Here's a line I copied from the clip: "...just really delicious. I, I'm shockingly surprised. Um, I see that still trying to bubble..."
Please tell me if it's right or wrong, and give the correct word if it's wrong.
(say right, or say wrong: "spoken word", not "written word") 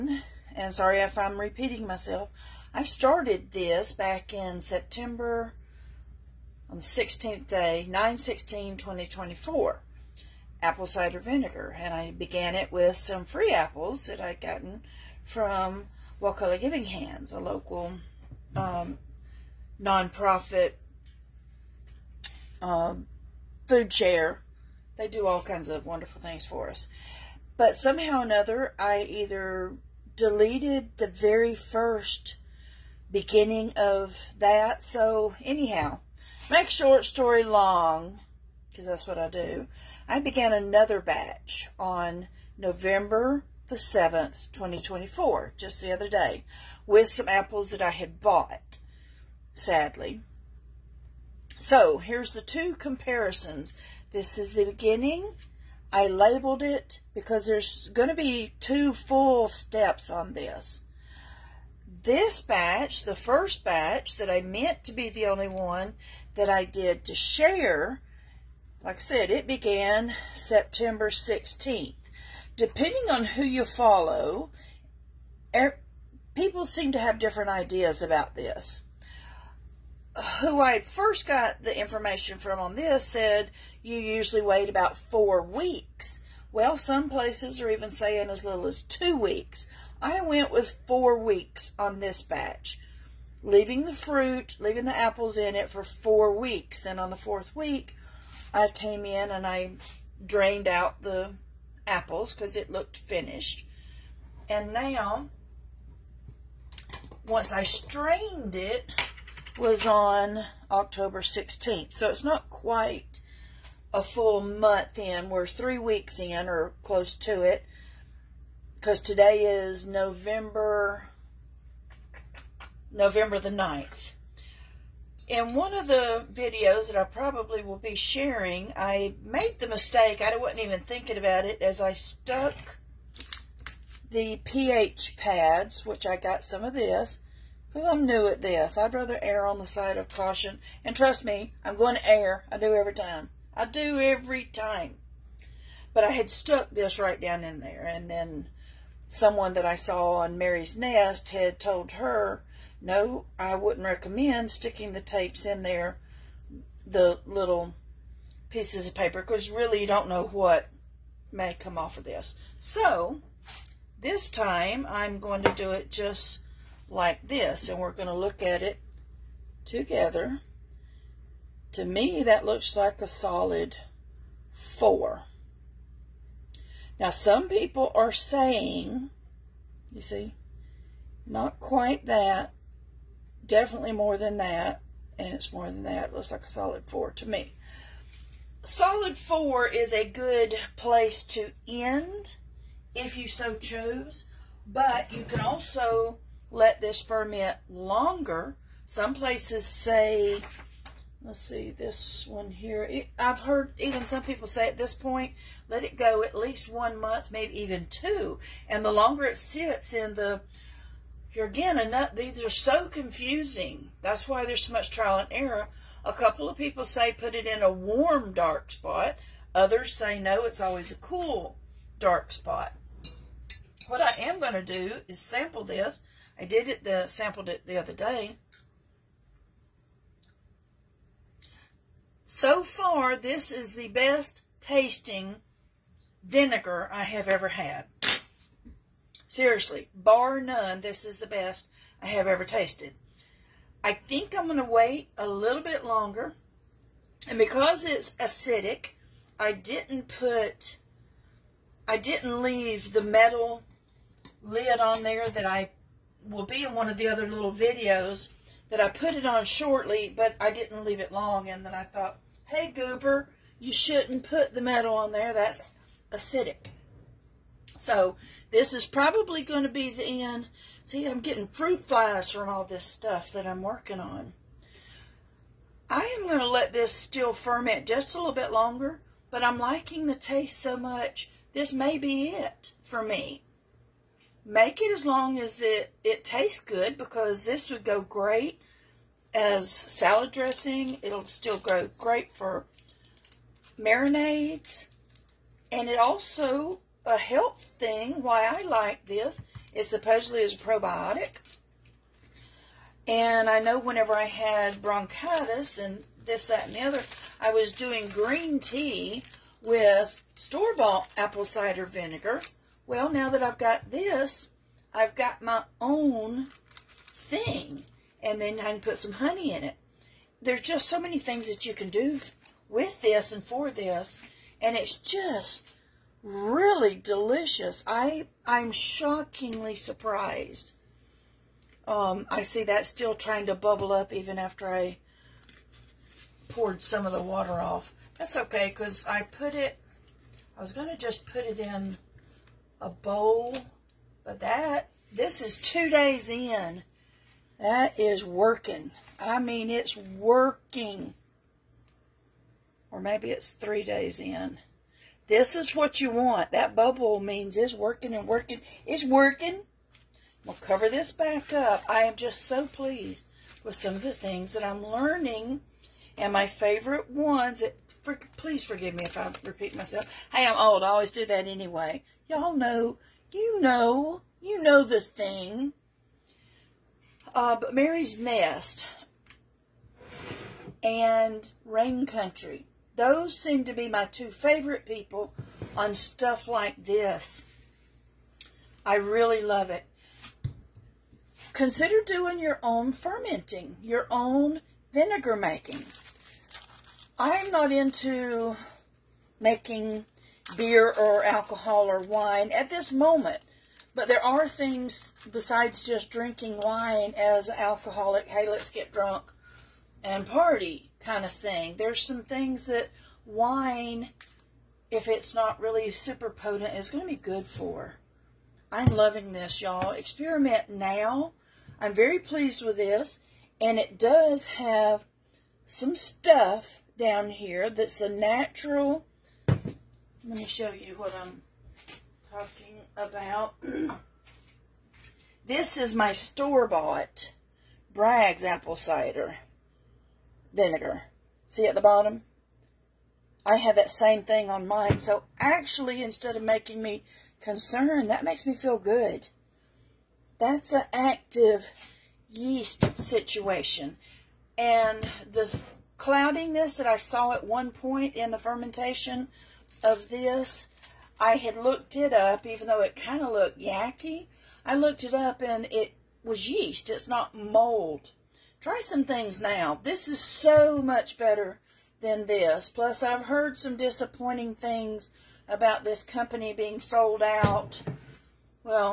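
right.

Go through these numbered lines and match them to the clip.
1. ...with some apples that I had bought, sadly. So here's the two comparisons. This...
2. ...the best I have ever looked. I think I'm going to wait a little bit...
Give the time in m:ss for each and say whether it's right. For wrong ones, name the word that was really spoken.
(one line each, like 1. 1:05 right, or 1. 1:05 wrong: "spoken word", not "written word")
1. 0:46 right
2. 4:01 wrong: "tasted", not "looked".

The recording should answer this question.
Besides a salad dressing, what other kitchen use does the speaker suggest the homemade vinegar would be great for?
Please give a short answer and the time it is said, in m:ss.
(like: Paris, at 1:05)
Marinades, at 4:53.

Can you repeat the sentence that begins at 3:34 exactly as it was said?
That's why there's so much trial and error.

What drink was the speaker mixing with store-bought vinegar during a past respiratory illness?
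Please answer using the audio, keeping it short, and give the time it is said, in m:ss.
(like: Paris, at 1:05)
Green tea, at 5:08.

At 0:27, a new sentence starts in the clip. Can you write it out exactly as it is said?
But somehow or another, I either deleted the very first beginning of that.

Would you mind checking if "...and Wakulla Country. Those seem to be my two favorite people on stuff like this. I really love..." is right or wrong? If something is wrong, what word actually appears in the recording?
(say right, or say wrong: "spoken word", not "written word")
wrong: "Rain", not "Wakulla".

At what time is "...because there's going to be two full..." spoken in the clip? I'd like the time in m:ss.
0:57.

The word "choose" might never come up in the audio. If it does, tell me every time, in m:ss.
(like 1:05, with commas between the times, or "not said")
3:13.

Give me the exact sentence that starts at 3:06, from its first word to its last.
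It looks like a solid four to me.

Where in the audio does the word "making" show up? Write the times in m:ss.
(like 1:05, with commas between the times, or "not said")
6:35, 6:39, 7:26.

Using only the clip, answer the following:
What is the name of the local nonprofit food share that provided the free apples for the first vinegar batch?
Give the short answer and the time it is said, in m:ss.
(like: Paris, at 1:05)
Wakulla Giving Hands, at 0:16.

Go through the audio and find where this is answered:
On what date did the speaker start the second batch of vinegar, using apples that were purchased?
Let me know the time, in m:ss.
0:42.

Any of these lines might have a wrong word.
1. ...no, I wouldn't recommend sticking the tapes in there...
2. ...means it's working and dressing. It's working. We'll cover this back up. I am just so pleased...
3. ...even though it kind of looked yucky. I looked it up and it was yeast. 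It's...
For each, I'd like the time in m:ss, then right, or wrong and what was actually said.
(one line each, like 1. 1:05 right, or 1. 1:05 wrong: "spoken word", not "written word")
1. 2:32 right
2. 5:57 wrong: "working", not "dressing"
3. 7:42 right.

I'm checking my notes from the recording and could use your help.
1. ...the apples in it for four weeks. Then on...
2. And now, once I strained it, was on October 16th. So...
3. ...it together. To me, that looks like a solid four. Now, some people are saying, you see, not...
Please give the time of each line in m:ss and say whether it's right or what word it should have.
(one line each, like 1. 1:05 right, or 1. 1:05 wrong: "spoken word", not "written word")
1. 1:34 right
2. 1:44 right
3. 2:48 right.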